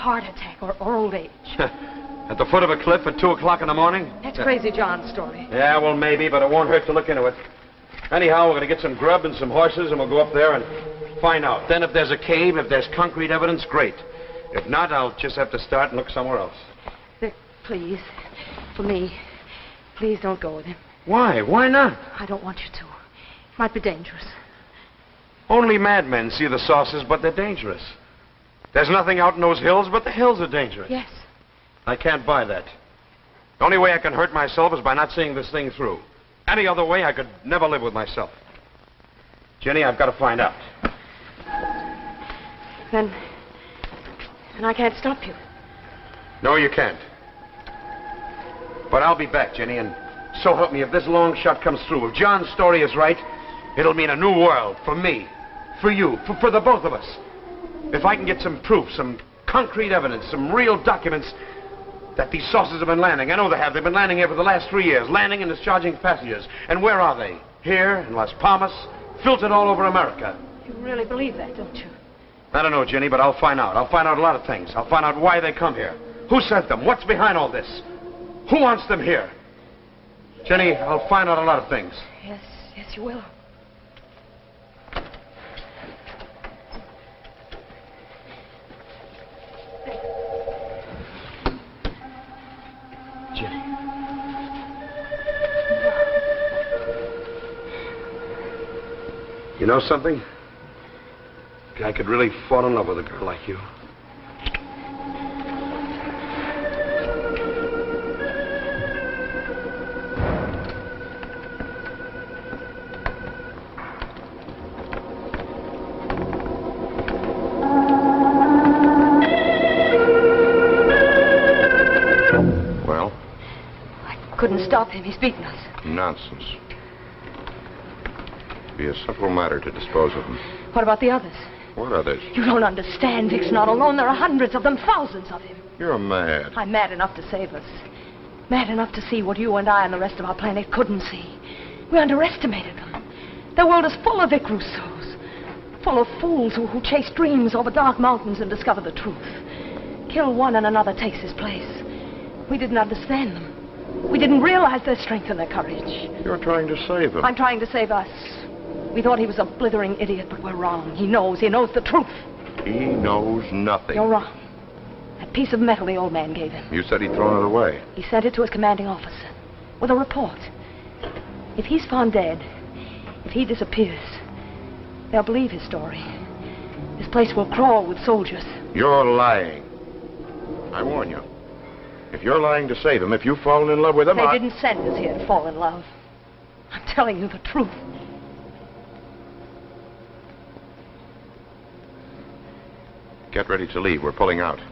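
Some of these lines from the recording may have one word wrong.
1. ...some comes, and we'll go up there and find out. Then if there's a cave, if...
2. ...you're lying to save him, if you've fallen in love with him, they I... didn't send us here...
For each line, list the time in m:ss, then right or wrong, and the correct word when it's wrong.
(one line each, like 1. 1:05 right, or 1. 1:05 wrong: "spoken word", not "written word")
1. 0:09 wrong: "horses", not "comes"
2. 3:02 right.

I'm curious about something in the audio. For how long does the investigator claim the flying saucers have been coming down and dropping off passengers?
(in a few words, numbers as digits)
3 years.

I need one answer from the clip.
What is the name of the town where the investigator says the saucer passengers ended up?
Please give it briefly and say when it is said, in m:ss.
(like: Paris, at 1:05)
Las Palmas, at 1:08.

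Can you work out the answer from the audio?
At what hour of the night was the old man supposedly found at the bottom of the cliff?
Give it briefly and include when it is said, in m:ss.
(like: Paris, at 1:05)
2 o'clock, at 0:03.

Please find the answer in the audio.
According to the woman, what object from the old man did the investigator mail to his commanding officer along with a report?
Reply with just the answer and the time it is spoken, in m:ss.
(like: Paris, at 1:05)
piece of metal, at 2:45.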